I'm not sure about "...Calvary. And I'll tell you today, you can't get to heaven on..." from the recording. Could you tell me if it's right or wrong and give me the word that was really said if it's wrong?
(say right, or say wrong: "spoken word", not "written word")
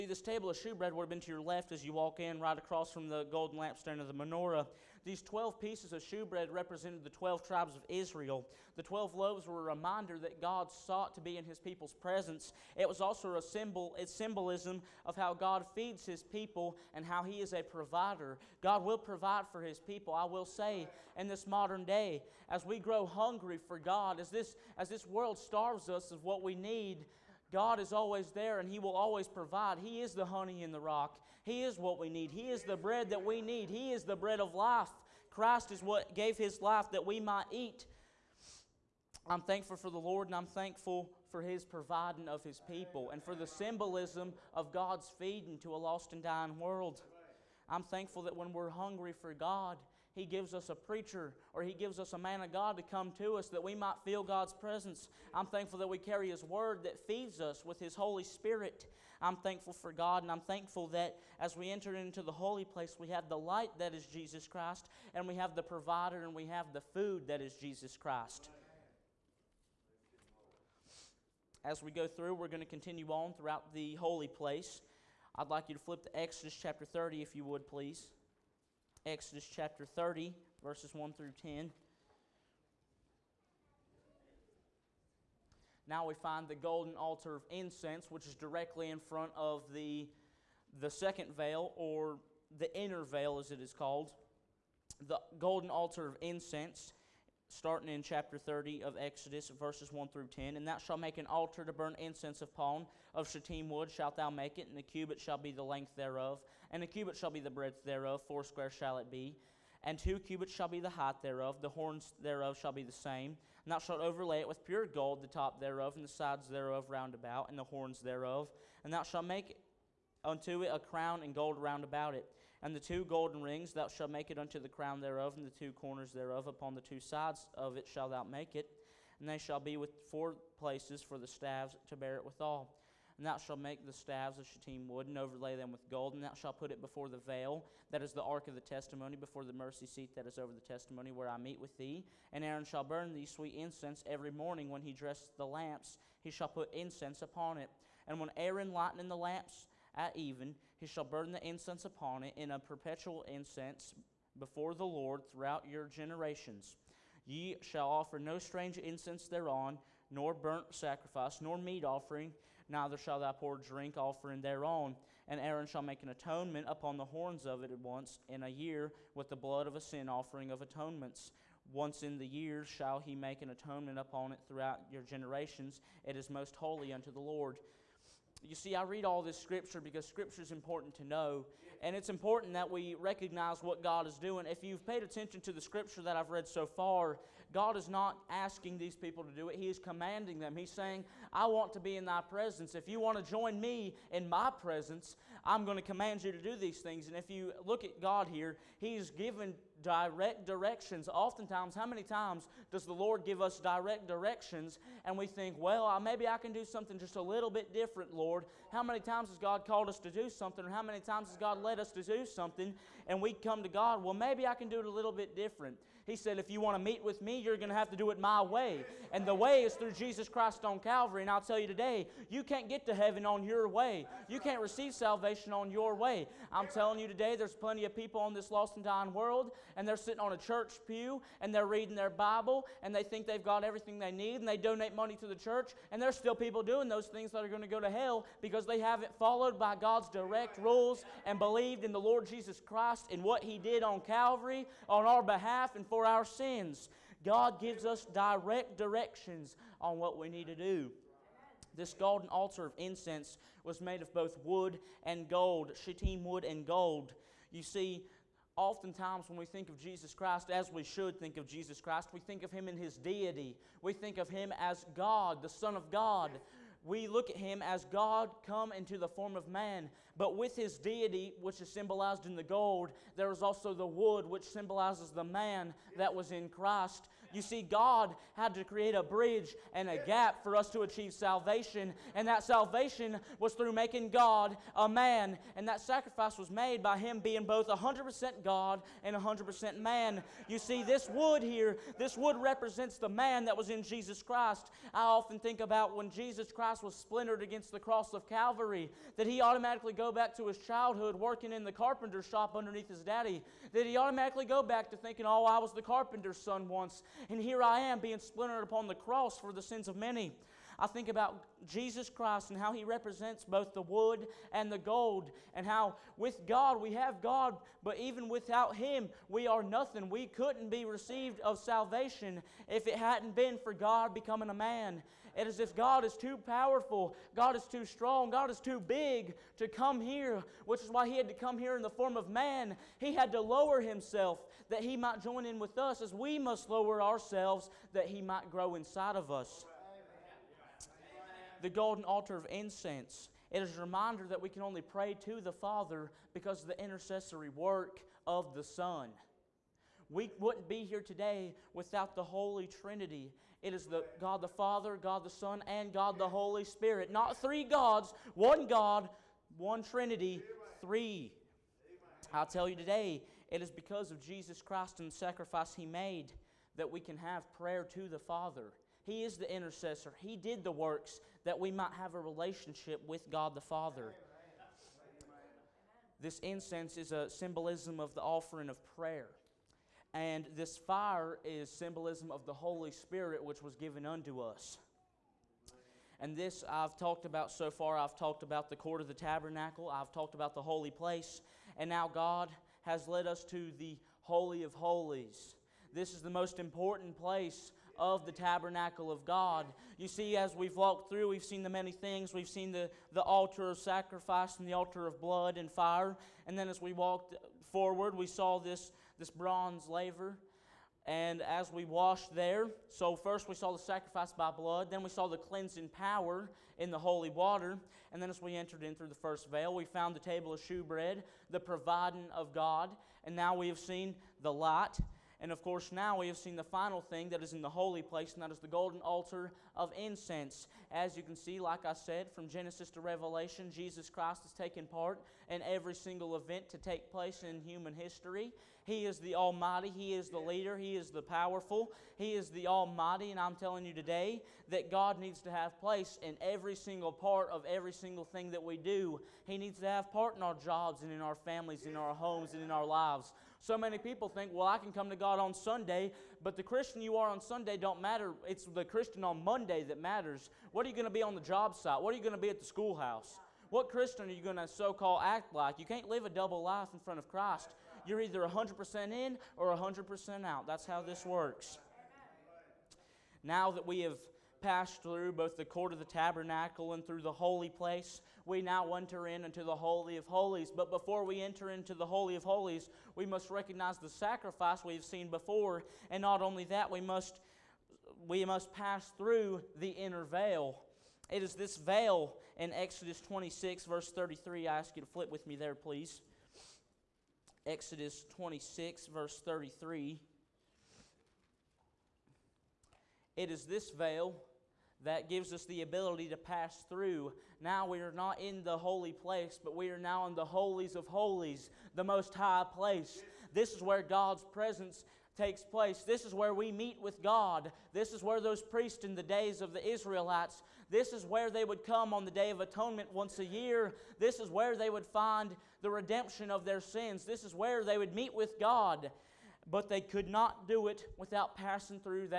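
right.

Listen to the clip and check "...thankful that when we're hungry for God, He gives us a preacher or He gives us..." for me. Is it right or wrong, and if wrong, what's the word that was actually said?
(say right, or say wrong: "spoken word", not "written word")
right.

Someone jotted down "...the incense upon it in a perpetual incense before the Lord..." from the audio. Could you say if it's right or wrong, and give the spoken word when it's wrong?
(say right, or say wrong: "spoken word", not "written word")
right.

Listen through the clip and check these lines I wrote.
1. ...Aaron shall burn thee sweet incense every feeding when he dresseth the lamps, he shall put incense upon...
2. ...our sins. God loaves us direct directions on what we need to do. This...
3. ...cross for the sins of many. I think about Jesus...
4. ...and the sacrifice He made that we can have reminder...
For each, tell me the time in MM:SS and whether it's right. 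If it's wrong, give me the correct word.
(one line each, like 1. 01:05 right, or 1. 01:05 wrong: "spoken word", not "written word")
1. 02:22 wrong: "morning", not "feeding"
2. 04:06 wrong: "gives", not "loaves"
3. 05:08 right
4. 06:04 wrong: "prayer", not "reminder".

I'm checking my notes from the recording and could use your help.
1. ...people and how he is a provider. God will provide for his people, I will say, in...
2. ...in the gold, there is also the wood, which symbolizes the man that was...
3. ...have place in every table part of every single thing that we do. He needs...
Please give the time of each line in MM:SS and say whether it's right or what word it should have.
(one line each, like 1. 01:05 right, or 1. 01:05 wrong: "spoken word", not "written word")
1. 00:16 right
2. 04:32 right
3. 07:25 wrong: "single", not "table".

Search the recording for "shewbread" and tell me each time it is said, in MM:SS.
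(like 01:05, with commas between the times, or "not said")
00:00, 00:06, 07:00.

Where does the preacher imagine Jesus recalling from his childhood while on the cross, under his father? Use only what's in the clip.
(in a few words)
the carpenter shop.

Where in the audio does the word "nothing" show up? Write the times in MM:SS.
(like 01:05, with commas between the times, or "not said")
05:19.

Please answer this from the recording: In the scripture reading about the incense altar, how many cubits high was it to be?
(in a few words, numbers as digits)
2.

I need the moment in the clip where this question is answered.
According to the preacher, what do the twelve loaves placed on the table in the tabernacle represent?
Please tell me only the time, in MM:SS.
00:07.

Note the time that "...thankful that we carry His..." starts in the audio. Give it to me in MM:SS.
00:55.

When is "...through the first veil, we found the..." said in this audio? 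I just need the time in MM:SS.
06:58.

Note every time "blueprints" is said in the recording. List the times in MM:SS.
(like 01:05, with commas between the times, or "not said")
not said.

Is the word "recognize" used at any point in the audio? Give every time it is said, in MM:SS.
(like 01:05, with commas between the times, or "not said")
03:02, 08:03.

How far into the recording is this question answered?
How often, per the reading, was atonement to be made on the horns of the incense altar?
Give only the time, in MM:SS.
02:47.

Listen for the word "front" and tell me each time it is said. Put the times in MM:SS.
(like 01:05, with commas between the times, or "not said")
01:28, 07:46.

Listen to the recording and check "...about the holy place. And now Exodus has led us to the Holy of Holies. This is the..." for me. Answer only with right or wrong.
wrong.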